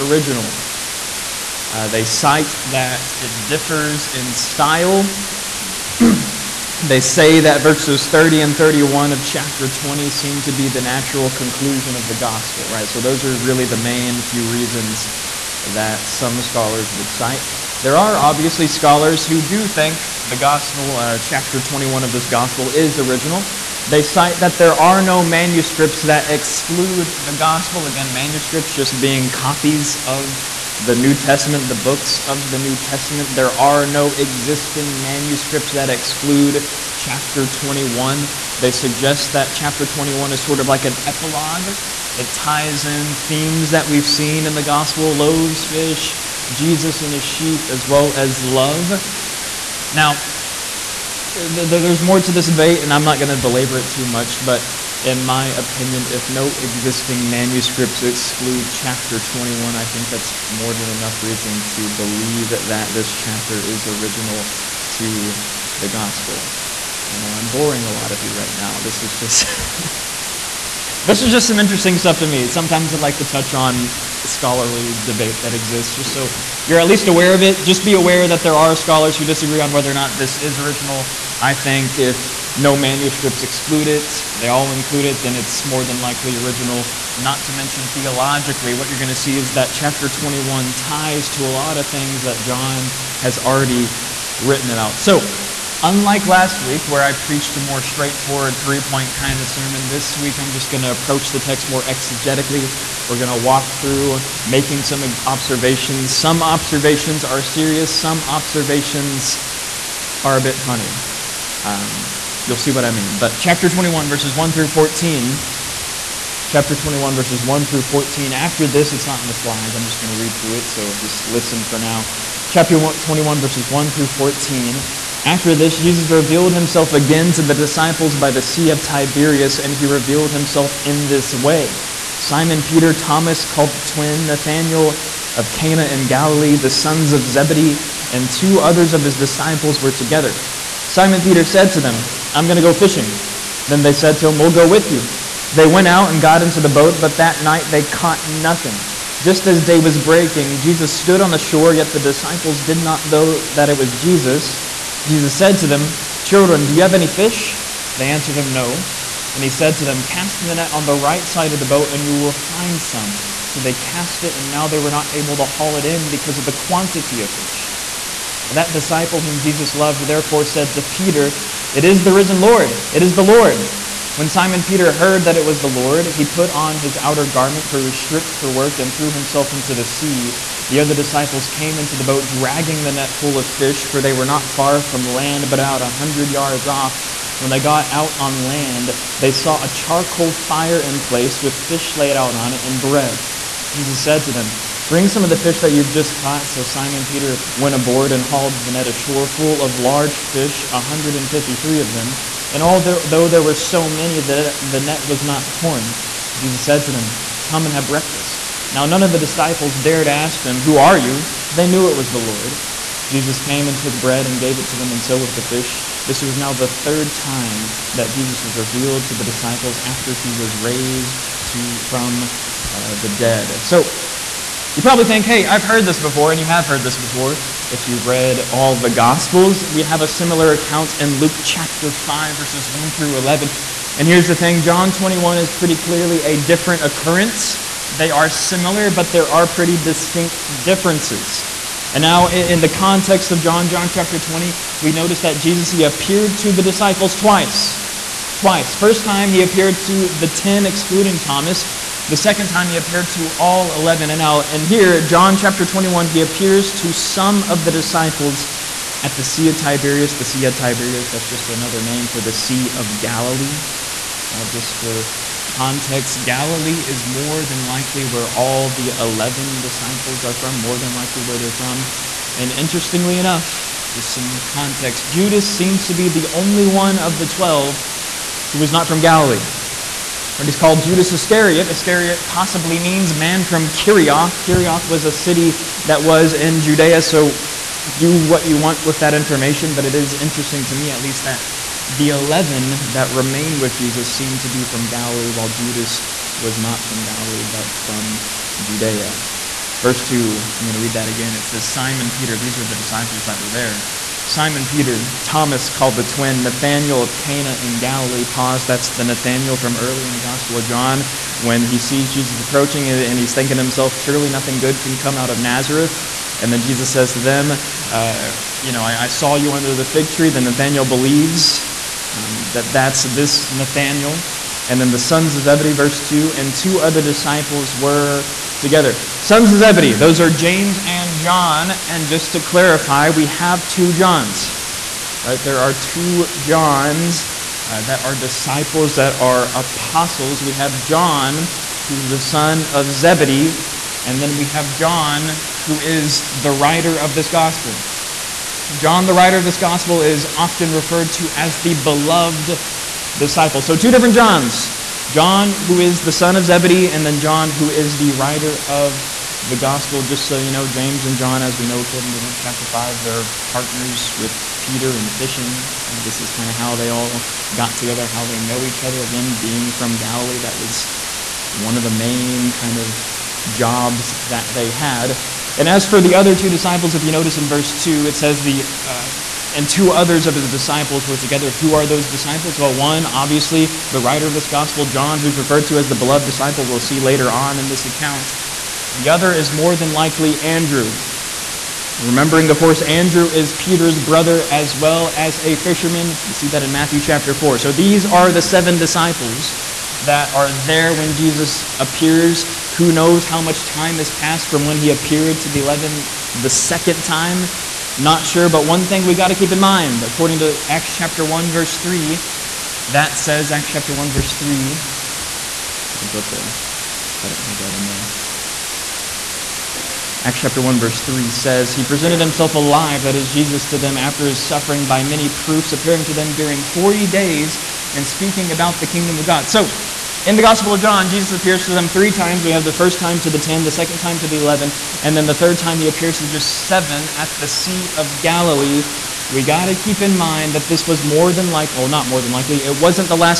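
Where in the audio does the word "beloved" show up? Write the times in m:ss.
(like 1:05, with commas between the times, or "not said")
5:51, 6:25.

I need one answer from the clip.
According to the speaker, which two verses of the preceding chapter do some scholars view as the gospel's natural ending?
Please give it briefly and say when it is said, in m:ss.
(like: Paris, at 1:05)
30 and 31, at 0:07.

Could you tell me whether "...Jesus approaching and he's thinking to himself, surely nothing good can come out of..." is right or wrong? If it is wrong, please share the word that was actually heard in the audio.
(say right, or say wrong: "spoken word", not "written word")
right.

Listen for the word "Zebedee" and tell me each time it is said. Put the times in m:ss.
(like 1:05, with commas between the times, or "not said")
2:17, 5:25, 5:29, 5:42, 5:56.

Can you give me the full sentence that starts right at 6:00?
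Just so you know, James and John, as we know according to Luke chapter 5, they're partners with Peter in fishing.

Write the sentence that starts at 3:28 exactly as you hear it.
Now, none of the disciples dared ask him, Who are you?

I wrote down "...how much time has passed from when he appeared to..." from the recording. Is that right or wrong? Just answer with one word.
right.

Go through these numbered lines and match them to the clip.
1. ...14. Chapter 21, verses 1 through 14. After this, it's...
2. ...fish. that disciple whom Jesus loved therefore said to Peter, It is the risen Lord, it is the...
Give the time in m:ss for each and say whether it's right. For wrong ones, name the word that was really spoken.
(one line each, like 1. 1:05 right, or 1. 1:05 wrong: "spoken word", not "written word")
1. 1:54 right
2. 2:47 right.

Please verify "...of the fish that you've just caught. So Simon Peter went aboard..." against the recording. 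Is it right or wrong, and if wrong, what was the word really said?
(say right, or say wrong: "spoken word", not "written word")
right.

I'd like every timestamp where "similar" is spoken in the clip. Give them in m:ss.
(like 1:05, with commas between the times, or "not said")
3:50, 3:58.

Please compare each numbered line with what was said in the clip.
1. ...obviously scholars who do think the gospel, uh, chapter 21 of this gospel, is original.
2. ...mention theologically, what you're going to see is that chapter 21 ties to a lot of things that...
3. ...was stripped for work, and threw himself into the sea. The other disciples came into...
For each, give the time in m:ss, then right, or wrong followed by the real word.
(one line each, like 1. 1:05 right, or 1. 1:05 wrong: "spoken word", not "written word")
1. 0:18 right
2. 1:27 right
3. 2:57 right.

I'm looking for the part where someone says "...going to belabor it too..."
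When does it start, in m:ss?
0:53.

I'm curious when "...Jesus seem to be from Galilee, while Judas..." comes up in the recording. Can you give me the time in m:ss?
4:53.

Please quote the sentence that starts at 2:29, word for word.
Just as day was breaking, Jesus stood on the shore, yet the disciples did not know that it was Jesus.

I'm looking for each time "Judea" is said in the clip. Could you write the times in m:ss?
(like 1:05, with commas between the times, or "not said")
4:46, 4:58.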